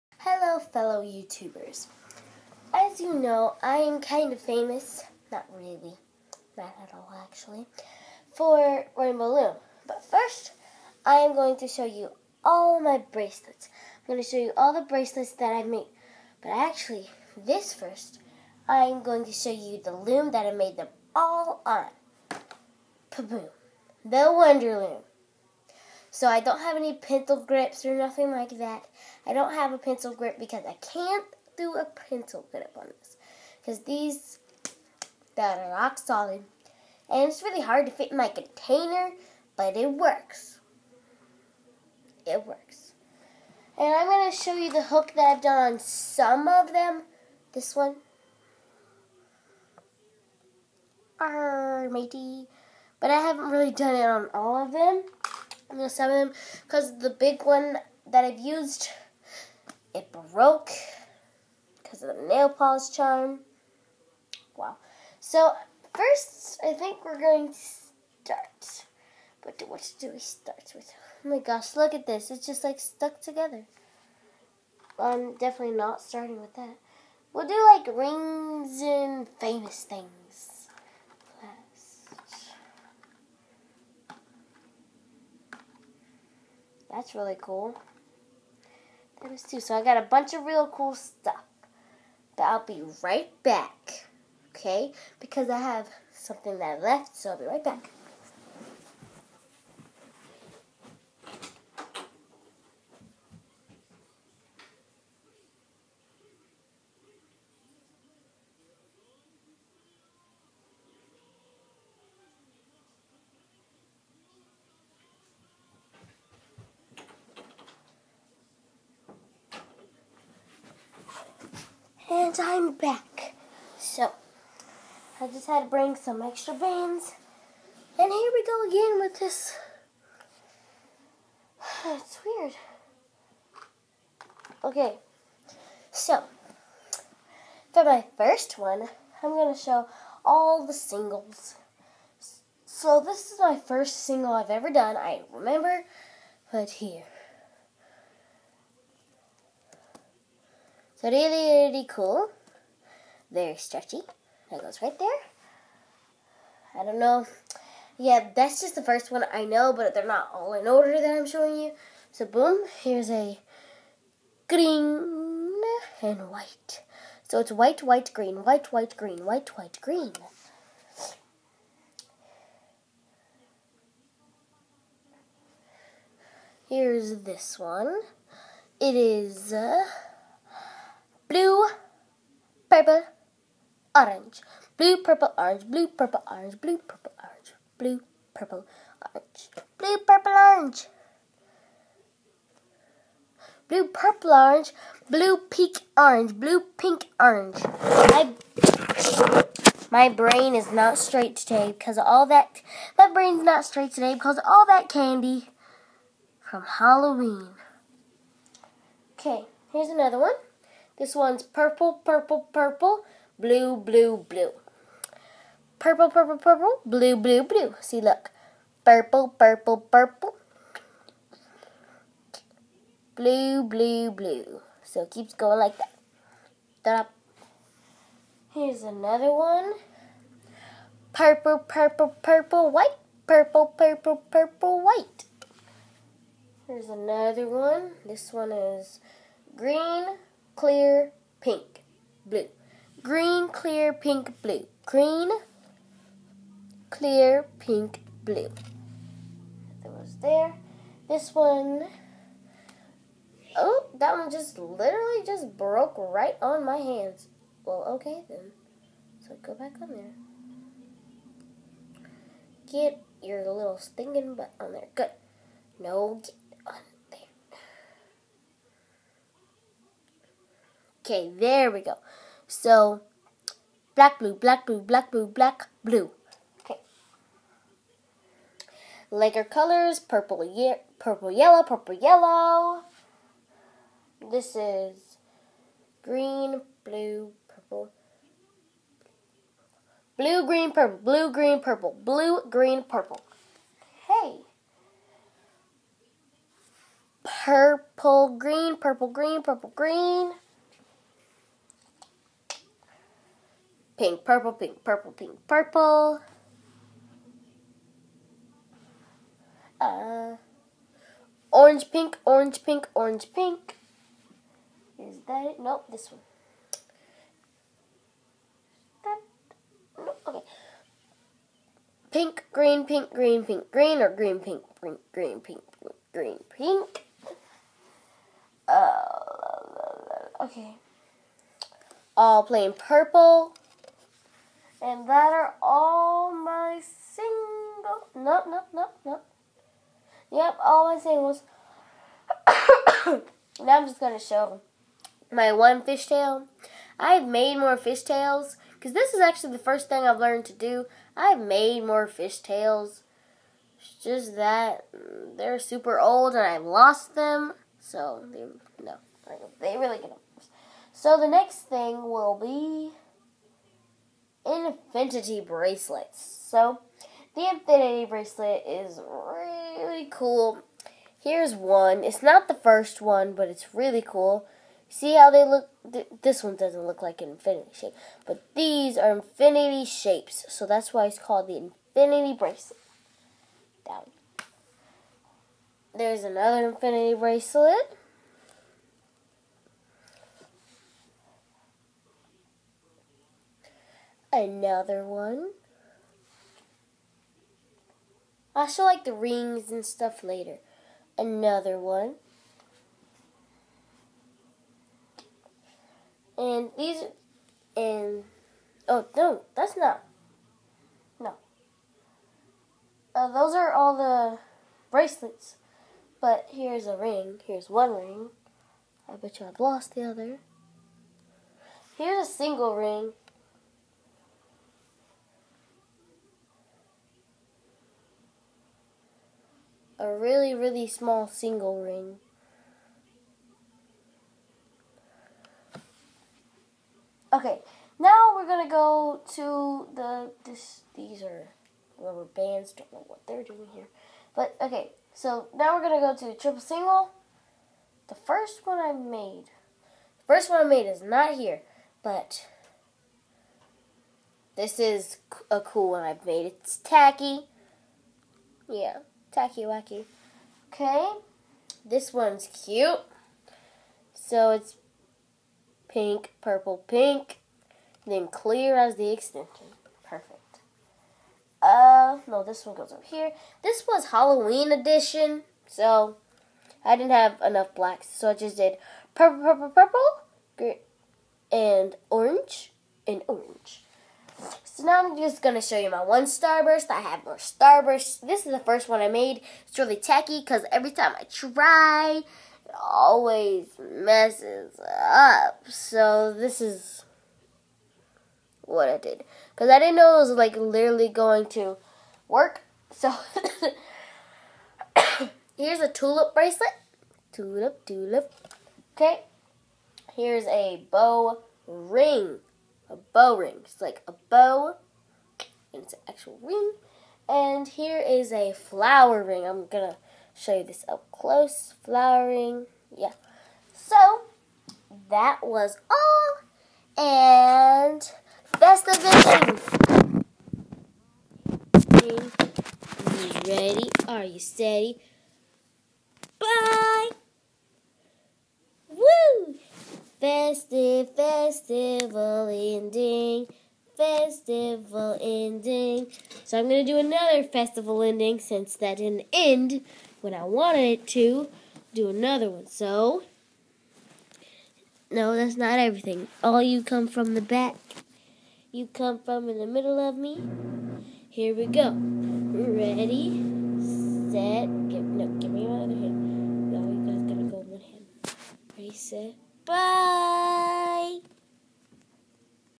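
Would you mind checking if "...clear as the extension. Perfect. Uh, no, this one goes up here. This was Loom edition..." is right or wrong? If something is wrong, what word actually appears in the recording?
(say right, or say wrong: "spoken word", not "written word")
wrong: "Halloween", not "Loom".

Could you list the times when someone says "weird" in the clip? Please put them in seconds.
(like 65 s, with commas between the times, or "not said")
132 s.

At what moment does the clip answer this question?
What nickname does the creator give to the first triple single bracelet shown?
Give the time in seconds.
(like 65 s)
459 s.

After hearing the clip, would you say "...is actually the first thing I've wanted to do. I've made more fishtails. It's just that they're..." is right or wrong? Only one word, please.
wrong.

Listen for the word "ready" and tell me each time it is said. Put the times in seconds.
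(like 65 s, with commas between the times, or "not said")
533 s, 561 s, 568 s.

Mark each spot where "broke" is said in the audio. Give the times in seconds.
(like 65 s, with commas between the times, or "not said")
60 s, 255 s.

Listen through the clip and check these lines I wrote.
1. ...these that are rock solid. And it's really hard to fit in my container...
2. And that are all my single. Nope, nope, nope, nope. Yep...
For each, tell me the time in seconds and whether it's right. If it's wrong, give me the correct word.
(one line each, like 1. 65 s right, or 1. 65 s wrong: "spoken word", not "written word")
1. 33 s right
2. 334 s right.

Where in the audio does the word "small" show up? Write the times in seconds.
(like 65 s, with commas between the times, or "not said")
430 s.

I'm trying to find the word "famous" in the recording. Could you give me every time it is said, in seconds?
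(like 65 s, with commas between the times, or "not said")
4 s, 79 s.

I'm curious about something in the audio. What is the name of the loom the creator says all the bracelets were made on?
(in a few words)
Wonder Loom.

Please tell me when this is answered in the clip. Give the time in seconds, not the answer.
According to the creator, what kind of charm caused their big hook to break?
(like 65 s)
62 s.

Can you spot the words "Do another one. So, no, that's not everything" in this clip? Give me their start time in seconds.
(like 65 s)
551 s.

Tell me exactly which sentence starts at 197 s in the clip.
I, my brain is not straight today because all that, my brain's not straight today because all that candy from Halloween.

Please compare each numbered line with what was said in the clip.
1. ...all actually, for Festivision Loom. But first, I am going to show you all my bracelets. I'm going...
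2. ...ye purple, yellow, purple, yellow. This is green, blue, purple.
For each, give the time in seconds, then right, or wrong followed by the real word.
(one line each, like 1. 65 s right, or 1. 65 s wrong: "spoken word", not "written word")
1. 6 s wrong: "Rainbow", not "Festivision"
2. 280 s right.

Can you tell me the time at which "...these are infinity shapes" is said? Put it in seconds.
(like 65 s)
378 s.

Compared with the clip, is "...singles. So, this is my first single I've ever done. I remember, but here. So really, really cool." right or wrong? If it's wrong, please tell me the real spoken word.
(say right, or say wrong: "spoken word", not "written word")
right.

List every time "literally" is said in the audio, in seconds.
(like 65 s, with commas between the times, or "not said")
254 s, 500 s.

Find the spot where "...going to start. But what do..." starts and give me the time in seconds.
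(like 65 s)
67 s.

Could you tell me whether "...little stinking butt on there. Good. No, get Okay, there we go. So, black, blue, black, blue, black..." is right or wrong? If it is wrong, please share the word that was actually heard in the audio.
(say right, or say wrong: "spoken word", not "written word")
right.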